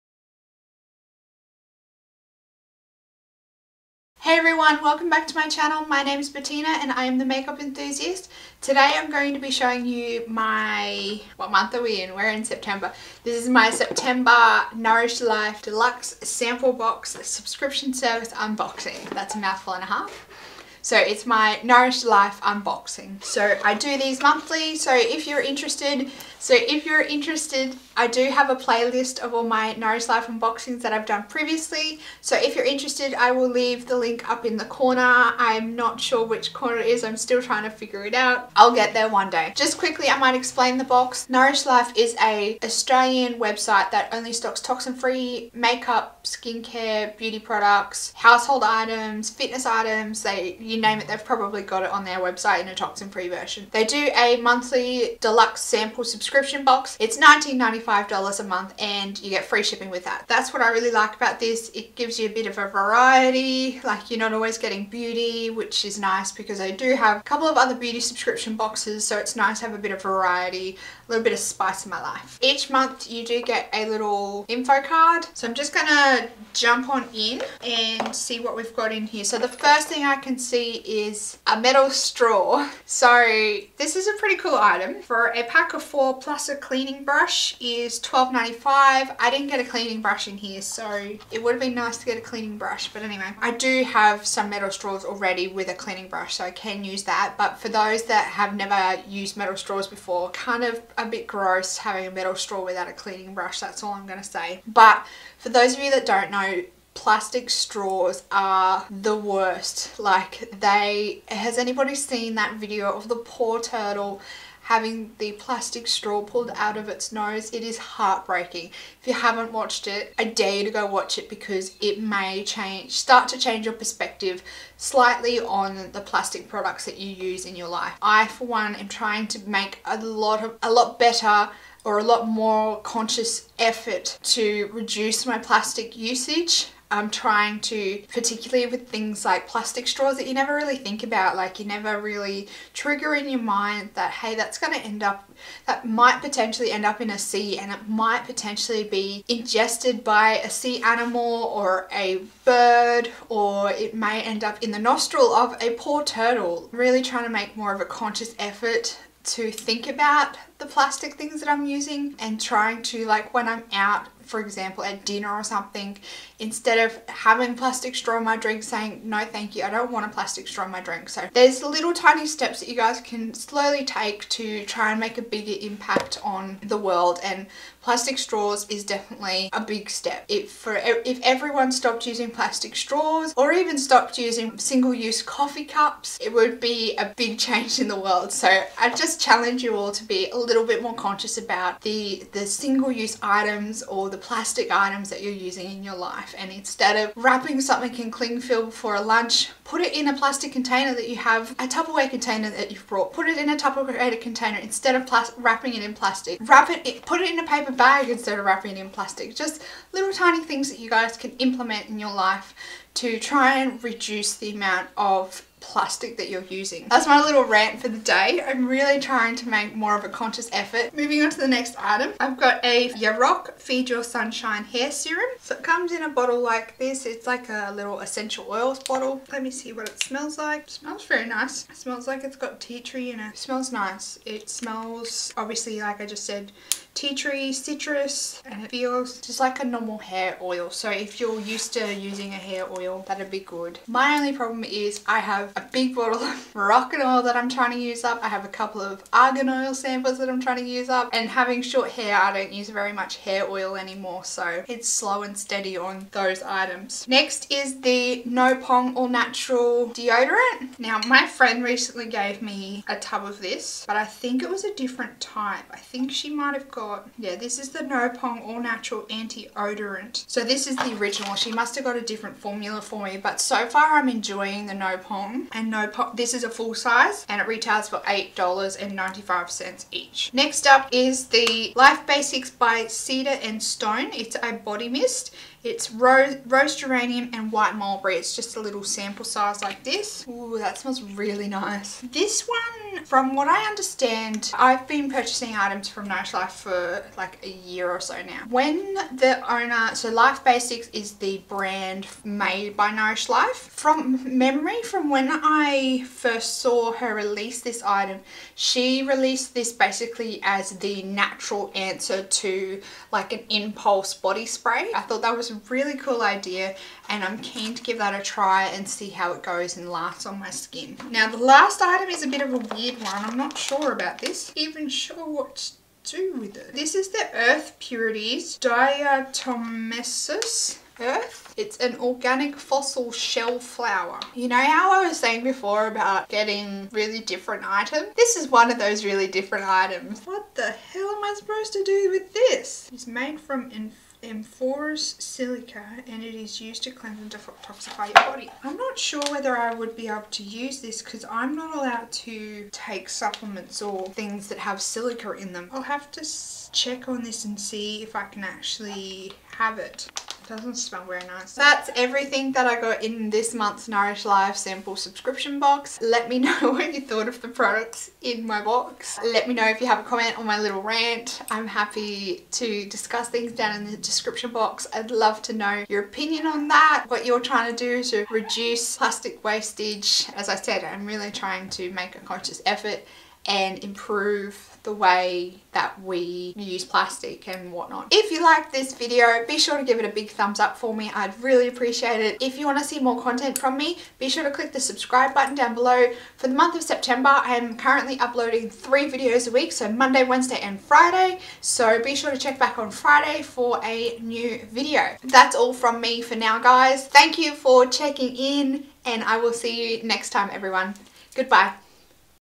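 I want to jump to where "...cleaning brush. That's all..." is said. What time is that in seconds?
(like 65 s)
102 s.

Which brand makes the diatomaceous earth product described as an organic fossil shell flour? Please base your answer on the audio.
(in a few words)
Earth Purities.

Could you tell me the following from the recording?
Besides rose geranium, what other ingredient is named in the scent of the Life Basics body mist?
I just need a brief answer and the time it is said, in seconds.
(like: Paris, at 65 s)
White mulberry, at 287 s.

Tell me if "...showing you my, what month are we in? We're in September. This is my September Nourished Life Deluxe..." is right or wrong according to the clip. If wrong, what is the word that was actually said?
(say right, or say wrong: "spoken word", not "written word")
right.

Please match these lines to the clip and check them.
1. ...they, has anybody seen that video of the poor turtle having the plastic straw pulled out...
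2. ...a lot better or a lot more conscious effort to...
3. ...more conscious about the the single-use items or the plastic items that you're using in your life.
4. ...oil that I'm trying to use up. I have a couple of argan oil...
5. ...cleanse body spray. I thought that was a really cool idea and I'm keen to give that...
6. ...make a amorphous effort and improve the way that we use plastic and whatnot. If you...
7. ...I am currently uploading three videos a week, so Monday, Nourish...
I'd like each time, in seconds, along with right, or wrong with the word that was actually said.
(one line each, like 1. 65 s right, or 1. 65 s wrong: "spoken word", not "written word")
1. 110 s right
2. 130 s right
3. 190 s right
4. 247 s right
5. 313 s wrong: "impulse", not "cleanse"
6. 381 s wrong: "conscious", not "amorphous"
7. 397 s wrong: "Wednesday", not "Nourish".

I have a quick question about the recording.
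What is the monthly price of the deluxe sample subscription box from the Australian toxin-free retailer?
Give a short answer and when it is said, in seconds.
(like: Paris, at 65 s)
$19.95, at 57 s.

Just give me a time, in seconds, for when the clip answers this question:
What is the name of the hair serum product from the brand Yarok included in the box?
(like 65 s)
223 s.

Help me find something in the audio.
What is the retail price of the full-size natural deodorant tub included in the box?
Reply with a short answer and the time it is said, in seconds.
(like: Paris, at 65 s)
$8.95, at 277 s.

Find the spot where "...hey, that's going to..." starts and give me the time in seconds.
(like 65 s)
144 s.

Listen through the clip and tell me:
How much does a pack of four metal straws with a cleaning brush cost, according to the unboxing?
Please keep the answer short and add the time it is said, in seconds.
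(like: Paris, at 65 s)
$12.95, at 87 s.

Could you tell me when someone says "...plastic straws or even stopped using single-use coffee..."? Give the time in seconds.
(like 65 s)
182 s.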